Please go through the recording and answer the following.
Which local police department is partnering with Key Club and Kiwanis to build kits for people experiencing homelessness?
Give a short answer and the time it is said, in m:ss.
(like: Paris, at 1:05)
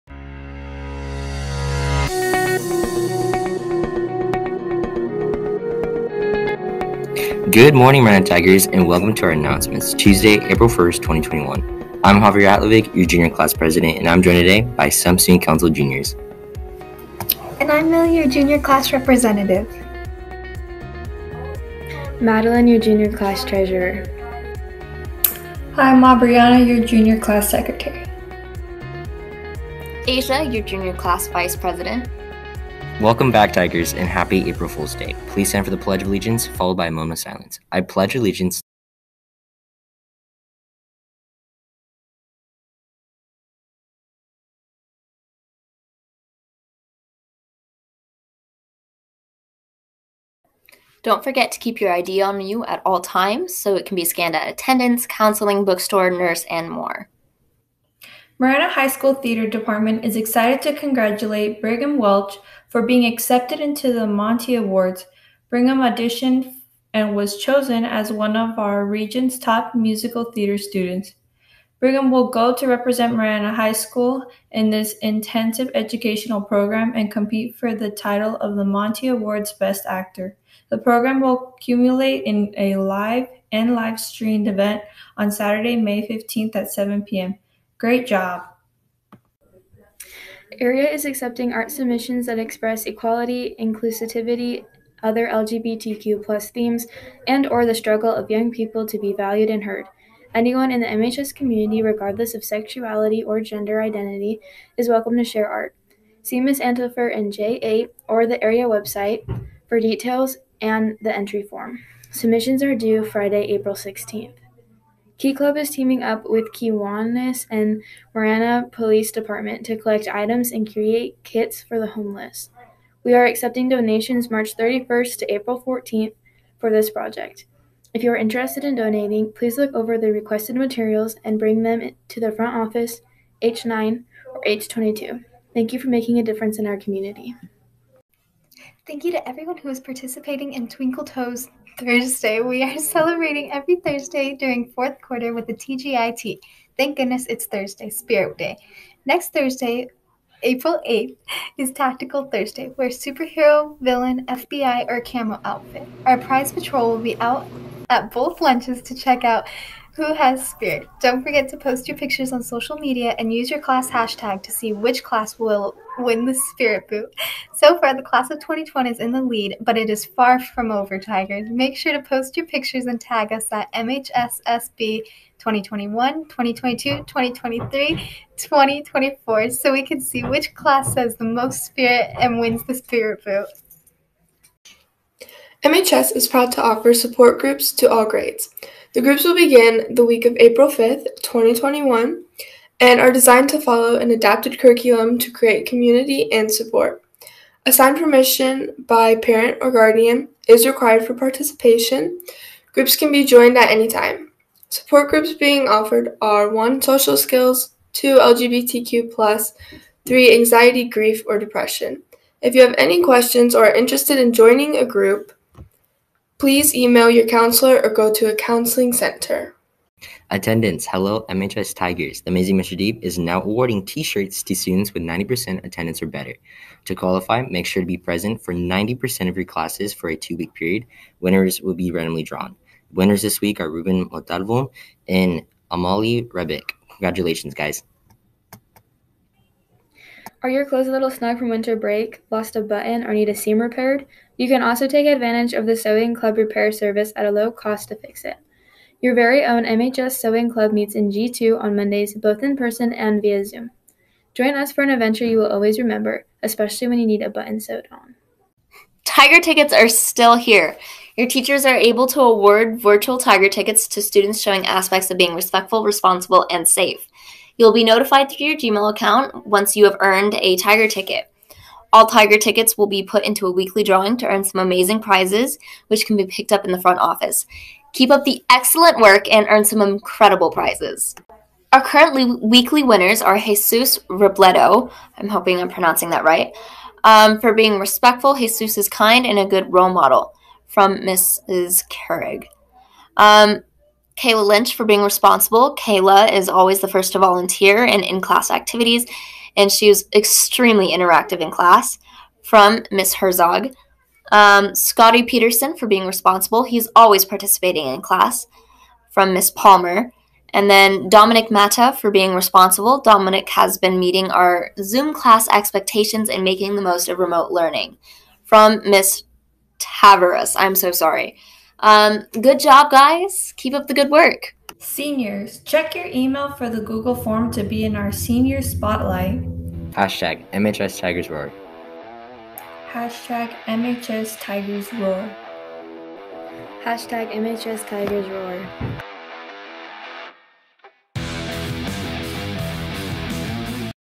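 Marana Police Department, at 1:58.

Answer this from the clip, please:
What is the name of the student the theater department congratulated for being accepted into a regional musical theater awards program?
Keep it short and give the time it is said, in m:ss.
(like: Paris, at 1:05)
Brigham Welch, at 1:01.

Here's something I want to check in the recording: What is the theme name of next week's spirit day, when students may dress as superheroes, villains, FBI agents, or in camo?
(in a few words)
Tactical Thursday.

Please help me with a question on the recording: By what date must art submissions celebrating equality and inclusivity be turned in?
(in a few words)
Friday, April 16th.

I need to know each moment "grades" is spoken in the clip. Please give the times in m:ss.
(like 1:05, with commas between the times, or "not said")
3:08.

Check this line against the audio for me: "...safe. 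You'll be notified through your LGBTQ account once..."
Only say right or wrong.
wrong.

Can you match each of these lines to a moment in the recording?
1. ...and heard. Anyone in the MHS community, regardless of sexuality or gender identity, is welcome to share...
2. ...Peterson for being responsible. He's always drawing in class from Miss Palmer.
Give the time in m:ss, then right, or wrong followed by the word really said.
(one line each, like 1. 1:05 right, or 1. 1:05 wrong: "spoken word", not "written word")
1. 1:39 right
2. 5:05 wrong: "participating", not "drawing".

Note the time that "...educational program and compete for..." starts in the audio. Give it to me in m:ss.
1:15.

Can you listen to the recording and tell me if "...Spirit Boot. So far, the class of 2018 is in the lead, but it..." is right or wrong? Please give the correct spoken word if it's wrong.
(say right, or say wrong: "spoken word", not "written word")
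wrong: "2020", not "2018".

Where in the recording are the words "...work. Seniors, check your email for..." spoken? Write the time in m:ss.
5:24.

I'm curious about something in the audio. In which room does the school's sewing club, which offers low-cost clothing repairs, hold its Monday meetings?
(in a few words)
G2.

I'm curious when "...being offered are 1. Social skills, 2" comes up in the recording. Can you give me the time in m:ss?
3:25.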